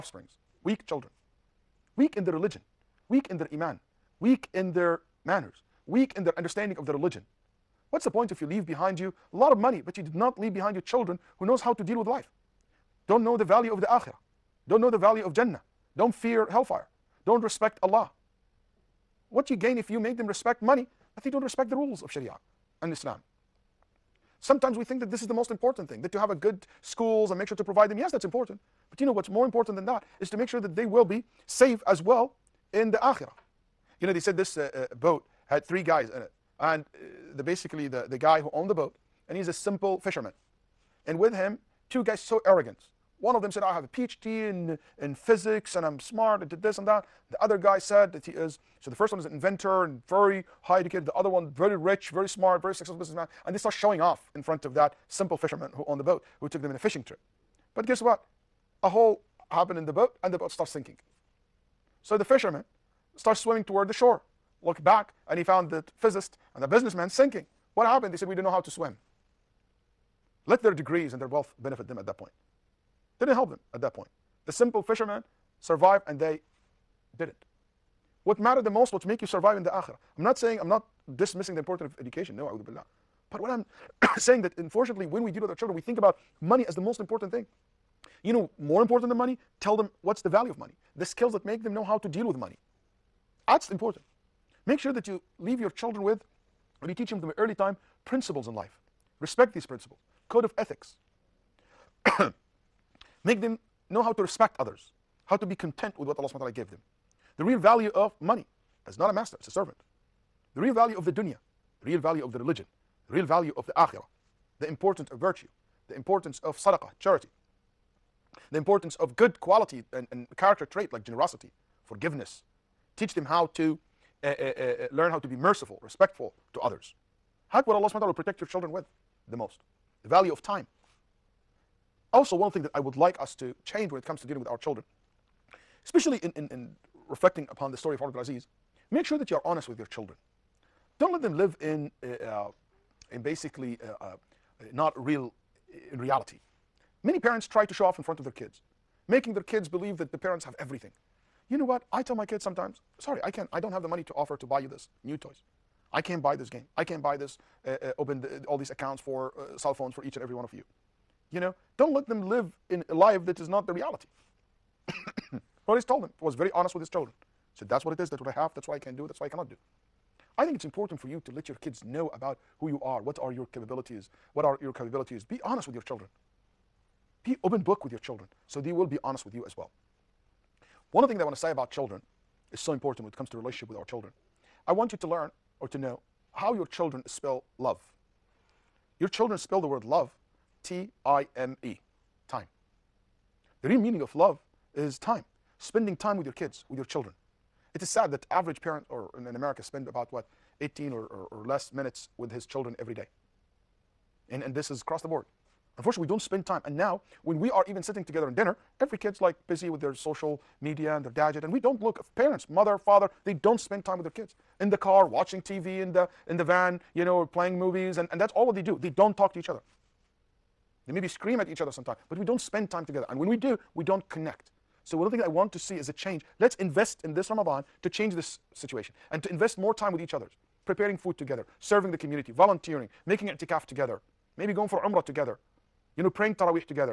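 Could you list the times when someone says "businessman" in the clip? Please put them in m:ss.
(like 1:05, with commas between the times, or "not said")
0:52, 1:06.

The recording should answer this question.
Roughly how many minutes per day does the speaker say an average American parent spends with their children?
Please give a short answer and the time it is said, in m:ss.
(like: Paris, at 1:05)
18, at 3:20.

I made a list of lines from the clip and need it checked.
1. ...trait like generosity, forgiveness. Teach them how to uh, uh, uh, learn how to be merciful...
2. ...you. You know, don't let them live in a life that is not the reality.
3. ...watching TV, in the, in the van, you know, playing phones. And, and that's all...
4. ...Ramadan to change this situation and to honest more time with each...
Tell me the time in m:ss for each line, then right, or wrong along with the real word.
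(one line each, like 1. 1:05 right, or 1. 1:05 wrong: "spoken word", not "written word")
1. 2:00 right
2. 2:40 right
3. 3:35 wrong: "movies", not "phones"
4. 3:47 wrong: "invest", not "honest".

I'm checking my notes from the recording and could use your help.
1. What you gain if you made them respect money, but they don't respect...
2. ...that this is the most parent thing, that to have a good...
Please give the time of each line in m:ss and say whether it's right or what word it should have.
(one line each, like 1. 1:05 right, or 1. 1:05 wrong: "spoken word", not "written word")
1. 0:19 right
2. 0:25 wrong: "important", not "parent".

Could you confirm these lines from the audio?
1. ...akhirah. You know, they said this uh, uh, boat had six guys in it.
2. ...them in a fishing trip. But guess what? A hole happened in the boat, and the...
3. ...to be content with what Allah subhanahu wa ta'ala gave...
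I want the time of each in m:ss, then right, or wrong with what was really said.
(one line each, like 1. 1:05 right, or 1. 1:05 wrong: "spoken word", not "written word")
1. 0:32 wrong: "three", not "six"
2. 0:56 right
3. 1:45 right.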